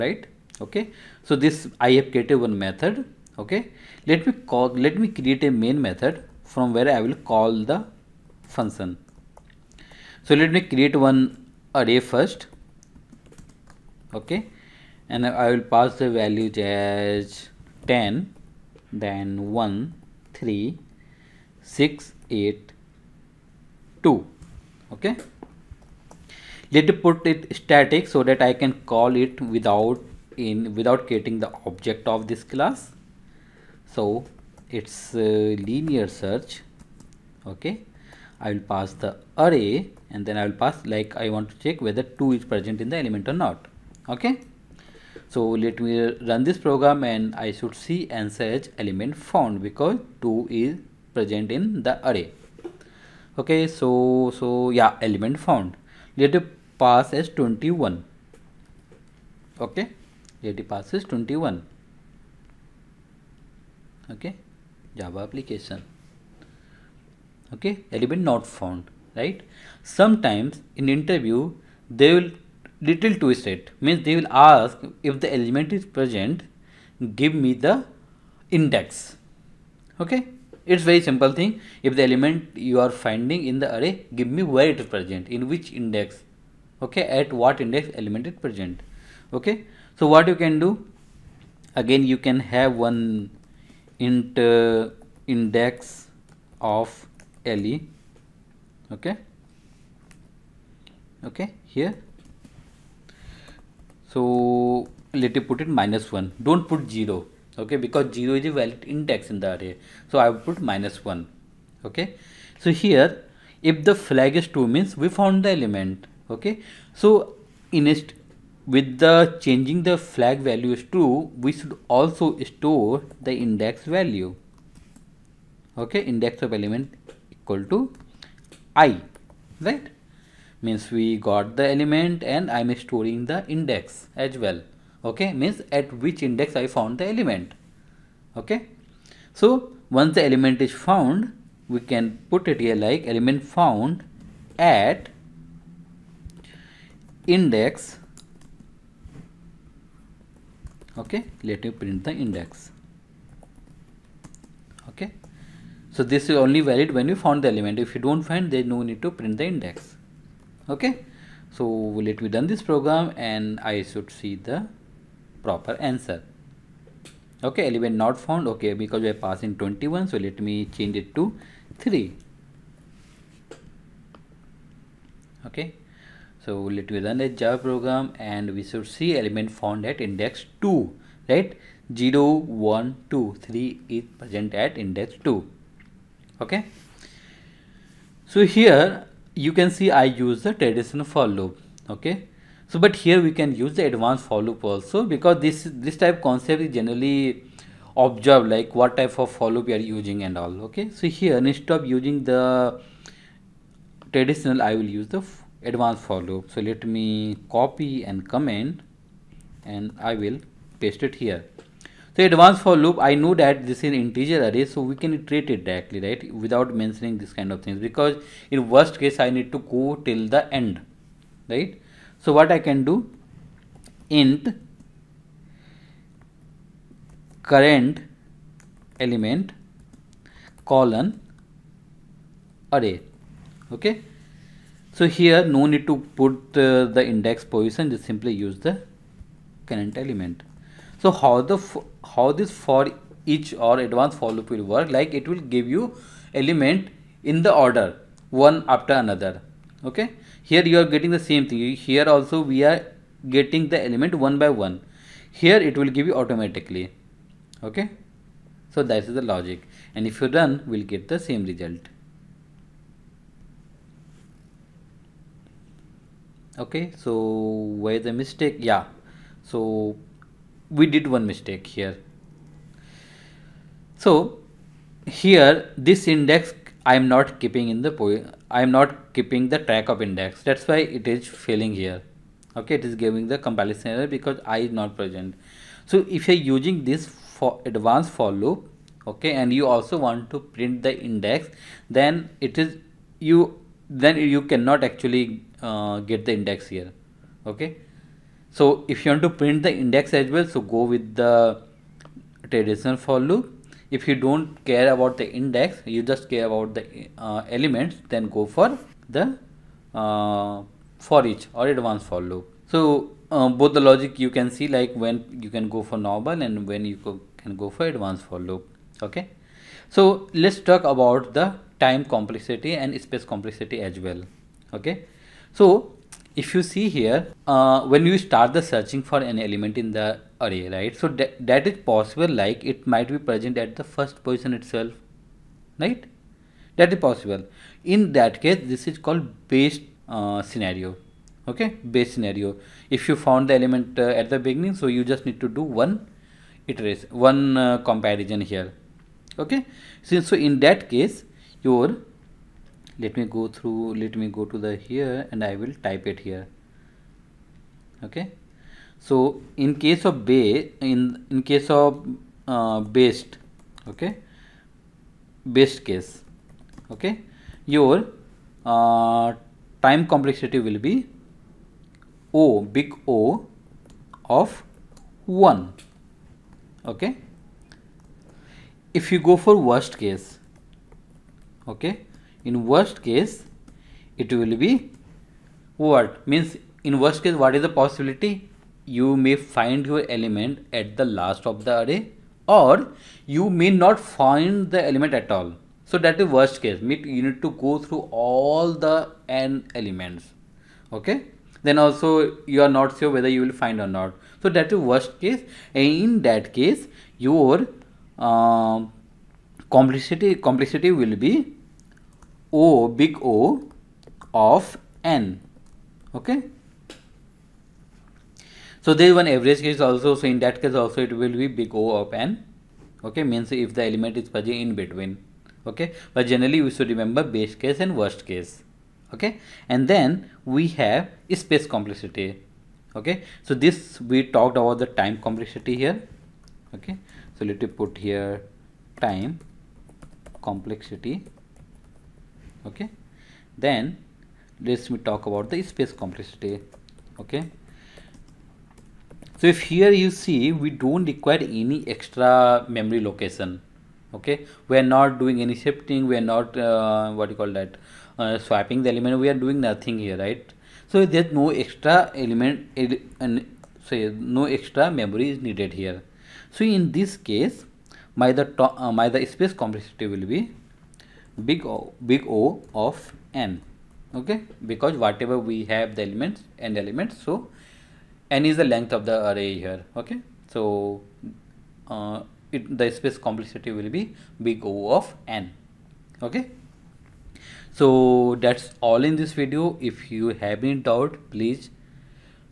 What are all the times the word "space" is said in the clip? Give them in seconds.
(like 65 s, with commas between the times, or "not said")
323 s, 431 s, 445 s, 469 s, 482 s.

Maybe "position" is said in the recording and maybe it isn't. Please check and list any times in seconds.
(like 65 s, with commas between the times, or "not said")
237 s, 334 s.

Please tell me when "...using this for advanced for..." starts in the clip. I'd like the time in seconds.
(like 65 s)
286 s.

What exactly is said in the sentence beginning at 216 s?
Without mentioning this kind of things because in worst case, I need to go till the end, right?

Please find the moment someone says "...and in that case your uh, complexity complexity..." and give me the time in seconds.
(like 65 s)
405 s.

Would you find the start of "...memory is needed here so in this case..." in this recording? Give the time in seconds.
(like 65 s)
464 s.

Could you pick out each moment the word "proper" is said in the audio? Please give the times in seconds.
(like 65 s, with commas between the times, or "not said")
165 s.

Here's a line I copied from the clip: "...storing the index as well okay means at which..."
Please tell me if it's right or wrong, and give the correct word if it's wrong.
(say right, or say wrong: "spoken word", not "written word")
right.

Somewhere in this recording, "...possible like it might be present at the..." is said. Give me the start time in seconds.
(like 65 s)
331 s.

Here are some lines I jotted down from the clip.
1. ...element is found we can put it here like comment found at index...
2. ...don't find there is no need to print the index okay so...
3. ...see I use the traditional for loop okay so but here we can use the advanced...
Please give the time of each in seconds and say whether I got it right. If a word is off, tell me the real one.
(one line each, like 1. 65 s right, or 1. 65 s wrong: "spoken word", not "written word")
1. 140 s wrong: "element", not "comment"
2. 158 s right
3. 189 s right.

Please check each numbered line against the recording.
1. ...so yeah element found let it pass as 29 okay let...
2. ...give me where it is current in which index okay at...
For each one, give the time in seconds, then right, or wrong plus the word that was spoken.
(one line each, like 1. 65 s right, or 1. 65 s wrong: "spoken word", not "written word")
1. 54 s wrong: "21", not "29"
2. 84 s wrong: "present", not "current".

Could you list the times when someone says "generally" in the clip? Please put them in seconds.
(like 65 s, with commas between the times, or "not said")
196 s, 426 s.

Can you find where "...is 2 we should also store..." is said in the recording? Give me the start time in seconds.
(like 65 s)
120 s.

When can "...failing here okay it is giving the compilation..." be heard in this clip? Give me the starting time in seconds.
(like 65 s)
281 s.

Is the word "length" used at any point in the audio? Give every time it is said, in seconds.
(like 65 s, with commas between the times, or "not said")
478 s.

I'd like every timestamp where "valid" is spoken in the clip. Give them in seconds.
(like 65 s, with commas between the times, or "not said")
108 s, 156 s.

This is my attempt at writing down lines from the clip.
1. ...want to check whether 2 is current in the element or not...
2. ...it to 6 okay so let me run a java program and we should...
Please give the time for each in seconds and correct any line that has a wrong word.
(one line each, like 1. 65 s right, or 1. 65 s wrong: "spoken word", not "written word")
1. 41 s wrong: "present", not "current"
2. 170 s wrong: "3", not "6".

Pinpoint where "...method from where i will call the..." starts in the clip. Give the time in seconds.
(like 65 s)
5 s.